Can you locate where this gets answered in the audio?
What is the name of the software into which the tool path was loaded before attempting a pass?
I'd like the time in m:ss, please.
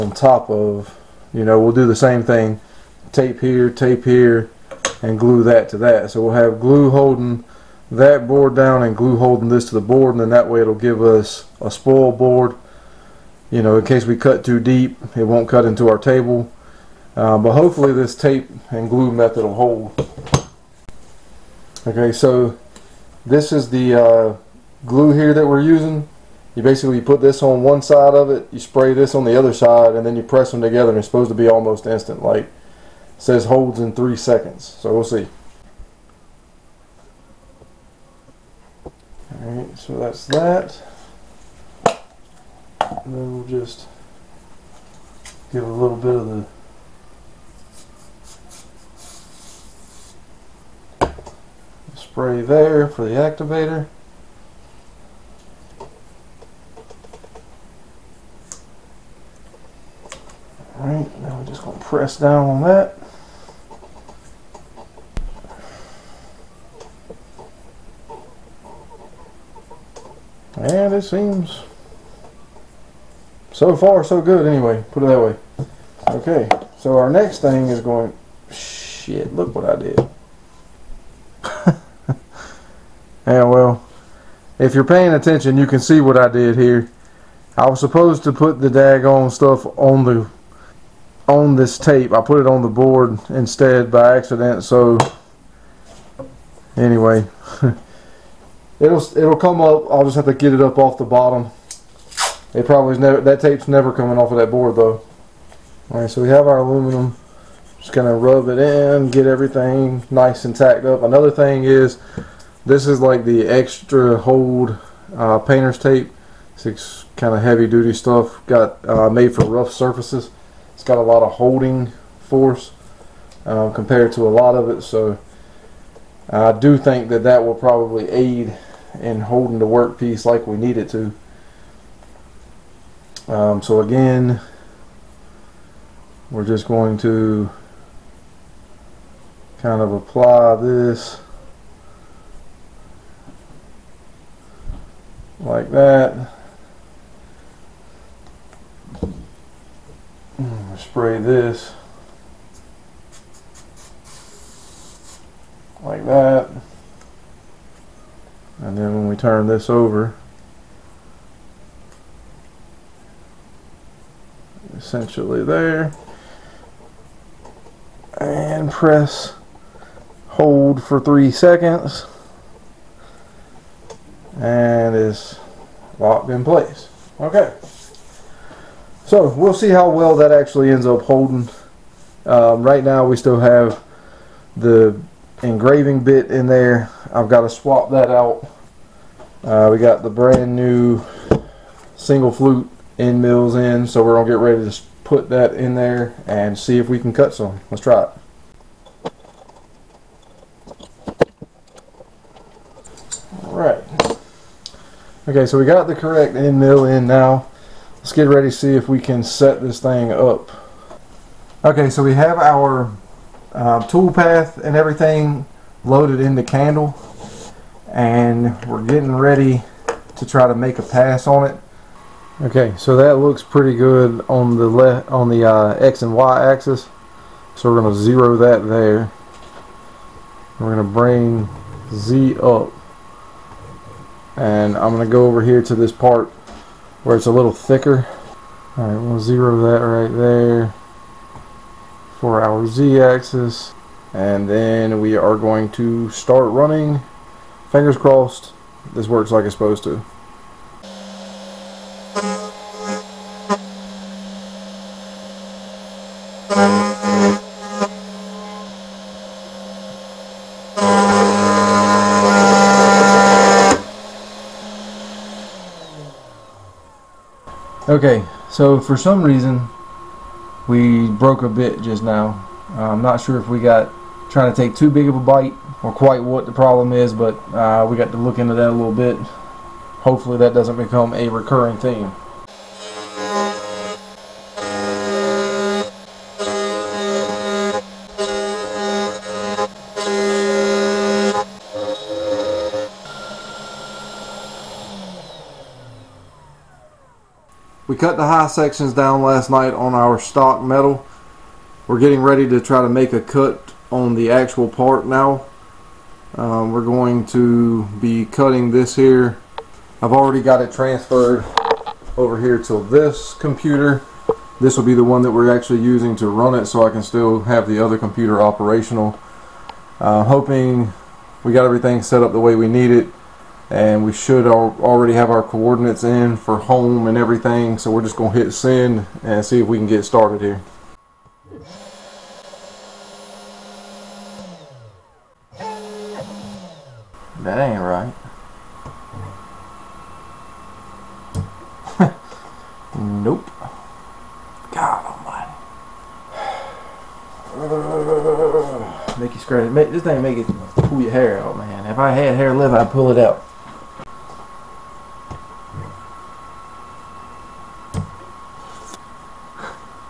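3:36.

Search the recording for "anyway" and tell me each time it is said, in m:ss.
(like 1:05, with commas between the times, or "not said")
1:14, 1:36.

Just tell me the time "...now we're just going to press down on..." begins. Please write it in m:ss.
1:01.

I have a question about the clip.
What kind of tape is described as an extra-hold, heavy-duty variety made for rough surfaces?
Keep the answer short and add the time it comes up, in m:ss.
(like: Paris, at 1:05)
Painter's tape, at 1:55.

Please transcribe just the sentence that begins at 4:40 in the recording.
Hopefully that doesn't become a recurring theme.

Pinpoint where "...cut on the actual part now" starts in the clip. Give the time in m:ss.
5:03.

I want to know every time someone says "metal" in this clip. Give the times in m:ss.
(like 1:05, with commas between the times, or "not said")
5:00.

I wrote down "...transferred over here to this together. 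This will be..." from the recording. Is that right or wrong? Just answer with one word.
wrong.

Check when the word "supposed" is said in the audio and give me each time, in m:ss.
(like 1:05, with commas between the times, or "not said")
0:31, 1:27, 4:09.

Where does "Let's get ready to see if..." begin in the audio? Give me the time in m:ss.
3:27.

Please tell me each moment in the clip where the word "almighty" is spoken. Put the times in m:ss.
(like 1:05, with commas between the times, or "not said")
5:45.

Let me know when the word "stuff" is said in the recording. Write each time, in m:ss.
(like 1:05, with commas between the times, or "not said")
1:29, 1:57.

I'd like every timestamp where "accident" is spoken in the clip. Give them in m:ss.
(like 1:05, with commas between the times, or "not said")
1:34.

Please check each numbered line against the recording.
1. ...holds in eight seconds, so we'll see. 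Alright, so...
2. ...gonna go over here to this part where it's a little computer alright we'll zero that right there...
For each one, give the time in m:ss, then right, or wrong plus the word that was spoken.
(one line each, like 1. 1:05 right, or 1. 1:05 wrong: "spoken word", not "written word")
1. 0:33 wrong: "three", not "eight"
2. 3:54 wrong: "thicker", not "computer".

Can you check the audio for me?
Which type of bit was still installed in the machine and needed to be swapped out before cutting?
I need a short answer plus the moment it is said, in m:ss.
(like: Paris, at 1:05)
Engraving bit, at 3:05.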